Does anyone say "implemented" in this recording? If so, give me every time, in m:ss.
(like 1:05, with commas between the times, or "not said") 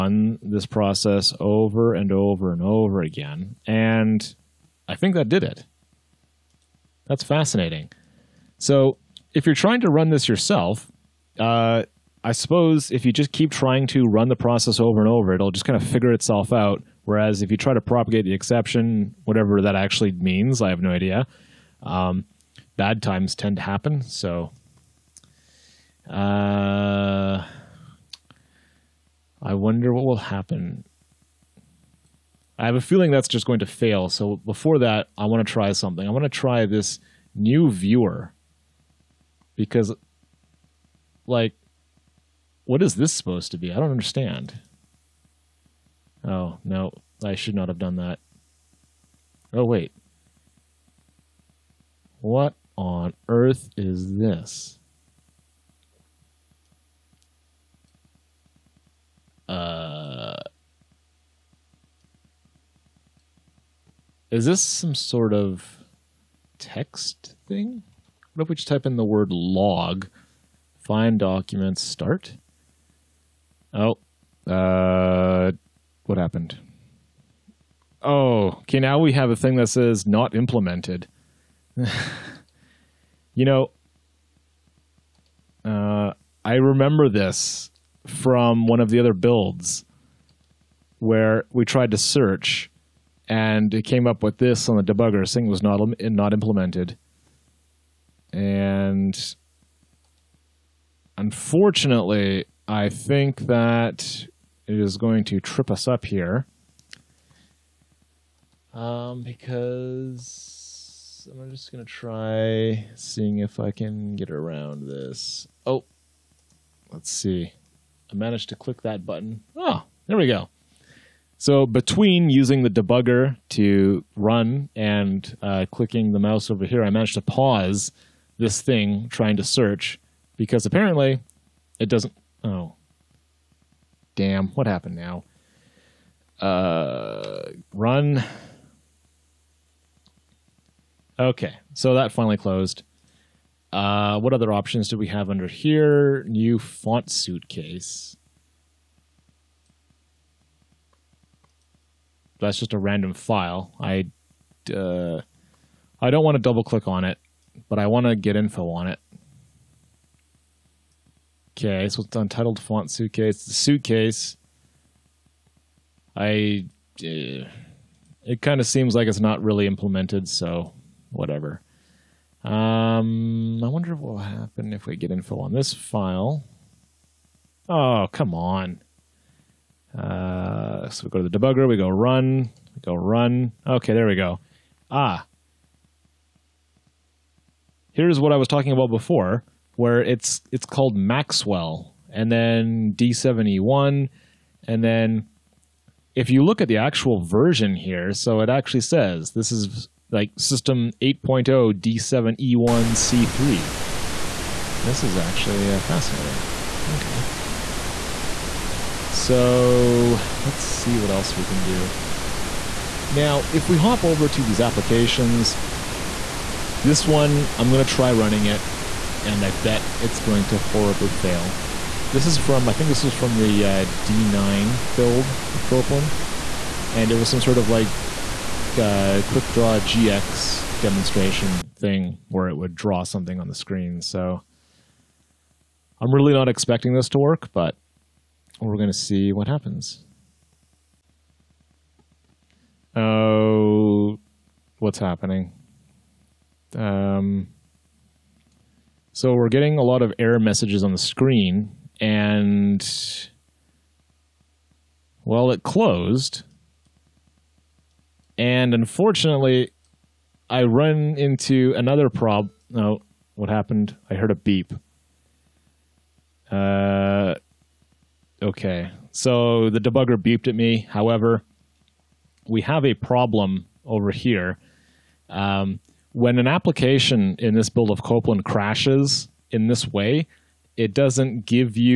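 1:20, 1:36, 2:49.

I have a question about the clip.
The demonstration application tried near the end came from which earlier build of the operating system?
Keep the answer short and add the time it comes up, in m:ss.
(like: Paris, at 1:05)
D9, at 3:44.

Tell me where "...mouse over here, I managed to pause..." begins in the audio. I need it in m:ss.
2:06.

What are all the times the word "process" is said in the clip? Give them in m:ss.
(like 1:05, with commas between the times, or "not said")
0:00, 0:14.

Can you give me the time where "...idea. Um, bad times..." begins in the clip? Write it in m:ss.
0:20.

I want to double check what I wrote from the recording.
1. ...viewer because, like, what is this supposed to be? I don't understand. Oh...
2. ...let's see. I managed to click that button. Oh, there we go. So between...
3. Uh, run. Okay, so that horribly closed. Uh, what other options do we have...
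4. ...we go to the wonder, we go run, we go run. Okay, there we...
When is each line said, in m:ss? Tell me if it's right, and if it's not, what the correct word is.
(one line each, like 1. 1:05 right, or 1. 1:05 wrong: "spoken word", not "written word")
1. 0:37 right
2. 1:56 right
3. 2:16 wrong: "finally", not "horribly"
4. 3:01 wrong: "debugger", not "wonder".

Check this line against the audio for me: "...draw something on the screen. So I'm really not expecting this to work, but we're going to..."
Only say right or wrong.
right.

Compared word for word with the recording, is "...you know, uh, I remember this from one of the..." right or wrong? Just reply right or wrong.
right.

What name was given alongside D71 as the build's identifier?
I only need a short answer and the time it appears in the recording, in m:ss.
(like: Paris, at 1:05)
Maxwell, at 3:10.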